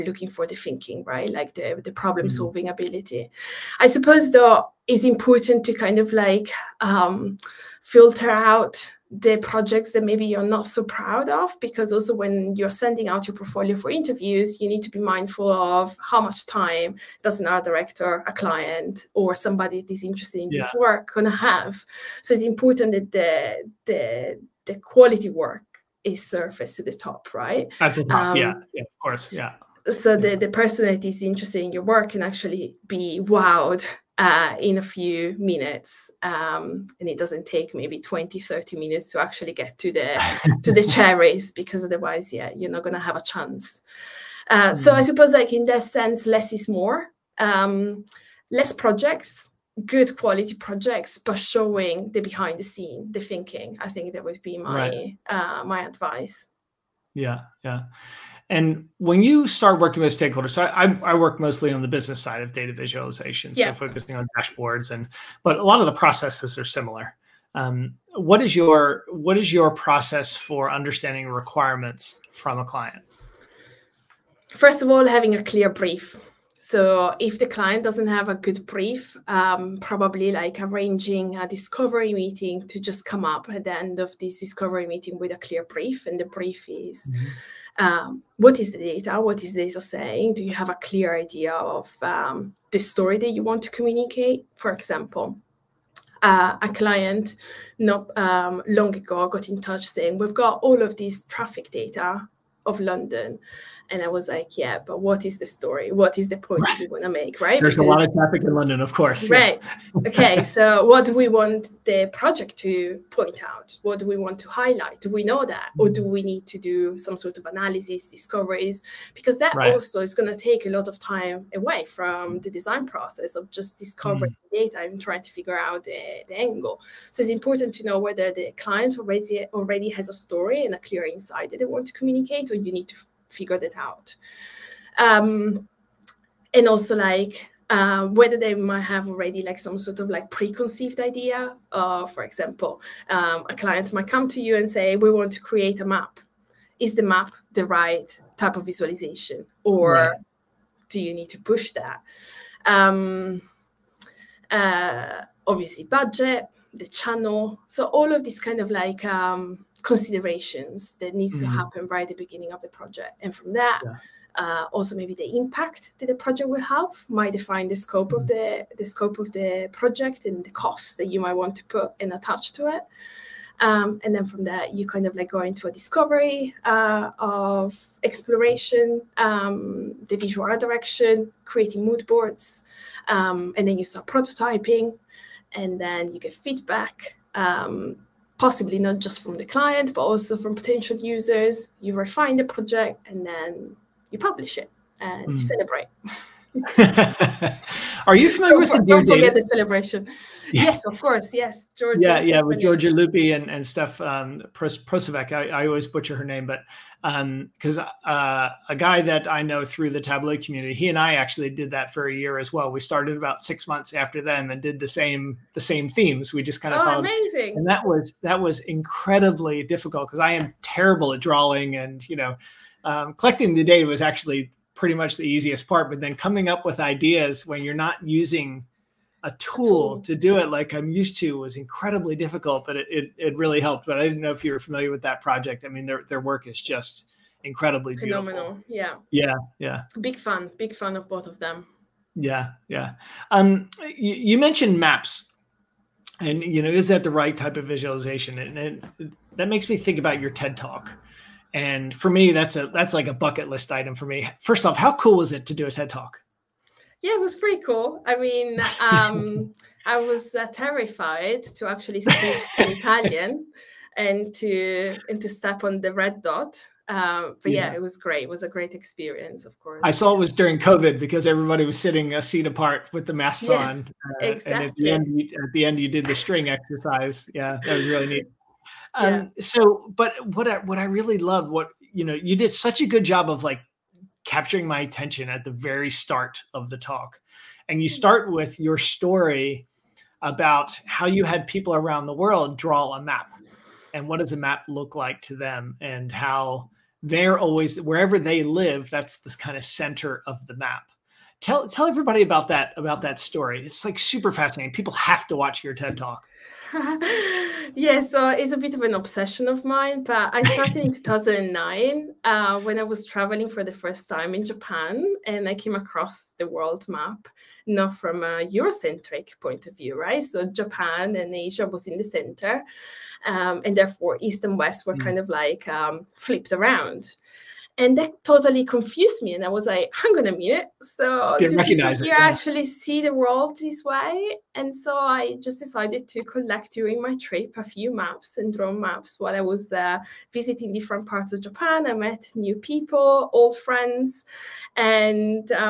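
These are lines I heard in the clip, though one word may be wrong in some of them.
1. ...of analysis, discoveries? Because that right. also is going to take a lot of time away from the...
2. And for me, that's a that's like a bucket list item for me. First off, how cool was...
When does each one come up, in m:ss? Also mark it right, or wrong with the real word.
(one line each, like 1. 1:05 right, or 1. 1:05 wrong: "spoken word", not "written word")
1. 1:57 right
2. 4:11 right.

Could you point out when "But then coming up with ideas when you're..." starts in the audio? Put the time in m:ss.
3:45.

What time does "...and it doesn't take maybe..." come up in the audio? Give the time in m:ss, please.
0:36.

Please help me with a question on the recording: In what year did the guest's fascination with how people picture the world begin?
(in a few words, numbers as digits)
2009.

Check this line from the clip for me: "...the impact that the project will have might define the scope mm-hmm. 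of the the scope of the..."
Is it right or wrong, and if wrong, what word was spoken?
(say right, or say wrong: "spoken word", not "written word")
right.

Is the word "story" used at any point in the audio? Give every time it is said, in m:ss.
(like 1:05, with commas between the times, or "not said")
1:32, 1:45, 2:10, 4:48, 5:03.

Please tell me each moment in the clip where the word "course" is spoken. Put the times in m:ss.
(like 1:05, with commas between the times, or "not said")
0:29, 1:48, 3:21, 4:29.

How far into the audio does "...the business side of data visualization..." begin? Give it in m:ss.
1:01.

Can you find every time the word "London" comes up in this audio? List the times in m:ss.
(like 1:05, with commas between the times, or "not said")
1:42, 1:48.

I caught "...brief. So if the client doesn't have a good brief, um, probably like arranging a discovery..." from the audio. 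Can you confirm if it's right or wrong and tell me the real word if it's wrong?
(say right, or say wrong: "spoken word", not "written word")
right.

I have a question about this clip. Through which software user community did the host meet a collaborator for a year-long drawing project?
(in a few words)
Tableau.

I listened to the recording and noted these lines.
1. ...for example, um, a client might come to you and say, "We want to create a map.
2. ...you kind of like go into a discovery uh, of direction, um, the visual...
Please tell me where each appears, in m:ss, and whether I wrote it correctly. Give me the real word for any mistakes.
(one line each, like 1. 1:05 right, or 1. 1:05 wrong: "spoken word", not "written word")
1. 2:22 right
2. 2:54 wrong: "exploration", not "direction".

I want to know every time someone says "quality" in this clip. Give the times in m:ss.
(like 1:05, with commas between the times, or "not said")
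0:24, 0:50.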